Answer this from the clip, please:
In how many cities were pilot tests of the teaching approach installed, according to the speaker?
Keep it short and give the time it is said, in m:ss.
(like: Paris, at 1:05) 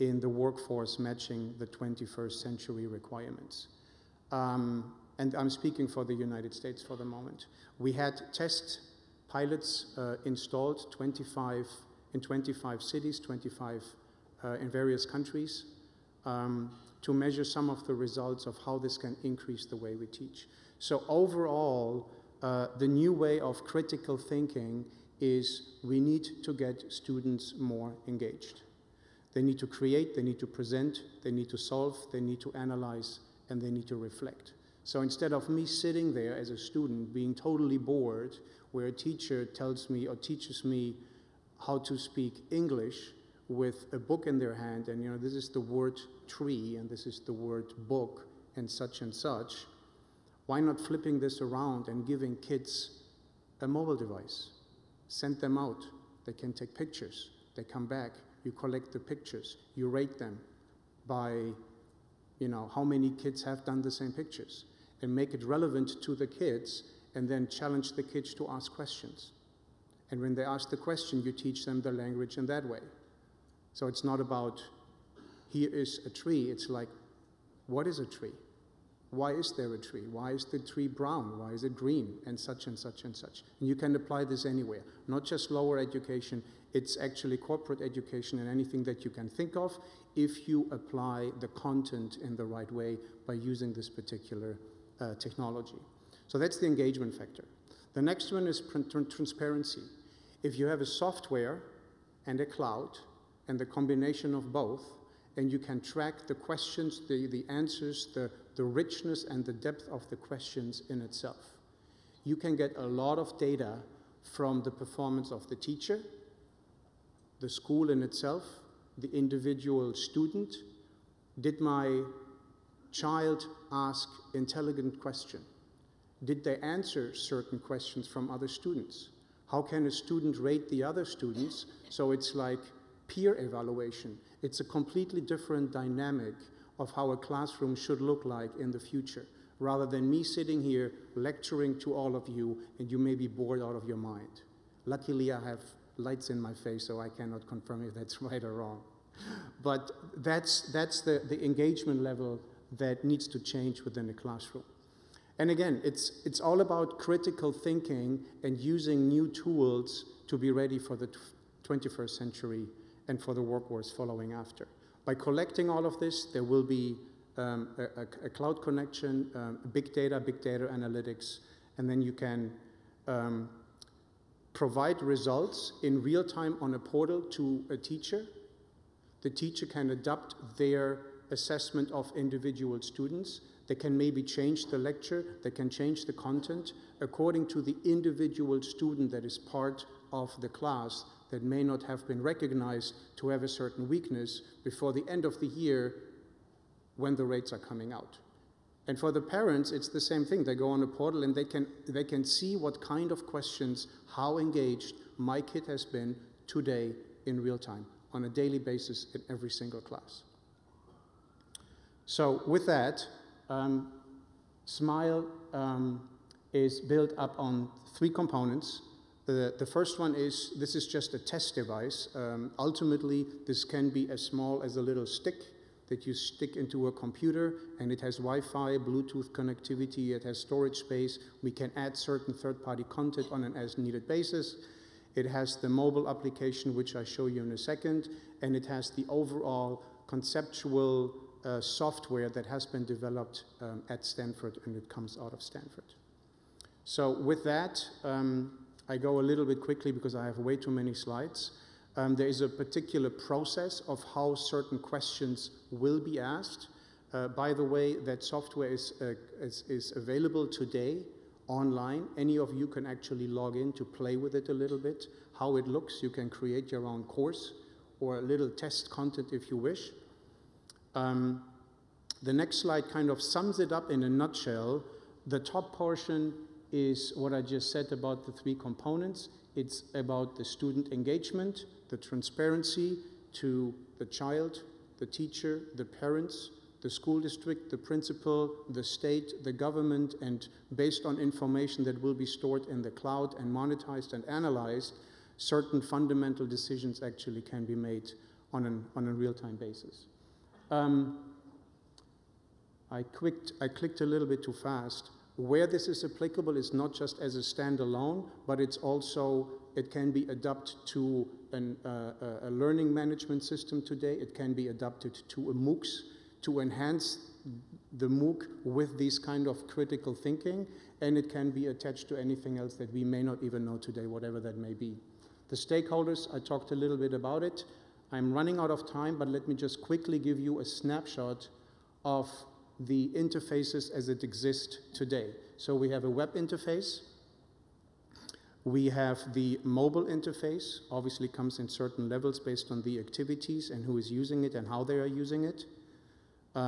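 25, at 0:12.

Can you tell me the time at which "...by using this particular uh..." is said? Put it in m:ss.
1:33.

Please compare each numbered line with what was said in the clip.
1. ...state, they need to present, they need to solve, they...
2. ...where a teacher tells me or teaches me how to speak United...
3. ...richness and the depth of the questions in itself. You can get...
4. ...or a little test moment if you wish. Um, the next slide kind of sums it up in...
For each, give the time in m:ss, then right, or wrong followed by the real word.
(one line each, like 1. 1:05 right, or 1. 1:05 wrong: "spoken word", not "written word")
1. 0:29 wrong: "create", not "state"
2. 0:38 wrong: "English", not "United"
3. 1:48 right
4. 4:28 wrong: "content", not "moment".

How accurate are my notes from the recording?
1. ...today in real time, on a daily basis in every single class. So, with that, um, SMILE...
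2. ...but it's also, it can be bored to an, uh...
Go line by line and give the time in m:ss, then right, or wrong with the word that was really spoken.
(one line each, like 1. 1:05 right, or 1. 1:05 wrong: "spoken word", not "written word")
1. 3:26 right
2. 5:08 wrong: "adapted", not "bored".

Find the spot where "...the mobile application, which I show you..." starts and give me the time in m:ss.
3:55.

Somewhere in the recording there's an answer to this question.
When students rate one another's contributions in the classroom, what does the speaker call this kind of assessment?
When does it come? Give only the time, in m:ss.
2:13.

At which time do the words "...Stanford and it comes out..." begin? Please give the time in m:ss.
4:04.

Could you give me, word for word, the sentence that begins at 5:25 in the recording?
The stakeholders, I talked a little bit about it.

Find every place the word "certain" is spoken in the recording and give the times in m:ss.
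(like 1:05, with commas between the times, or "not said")
2:07, 3:13, 3:51, 4:14, 4:55, 5:41.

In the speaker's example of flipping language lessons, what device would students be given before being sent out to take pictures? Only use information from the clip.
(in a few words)
A mobile device.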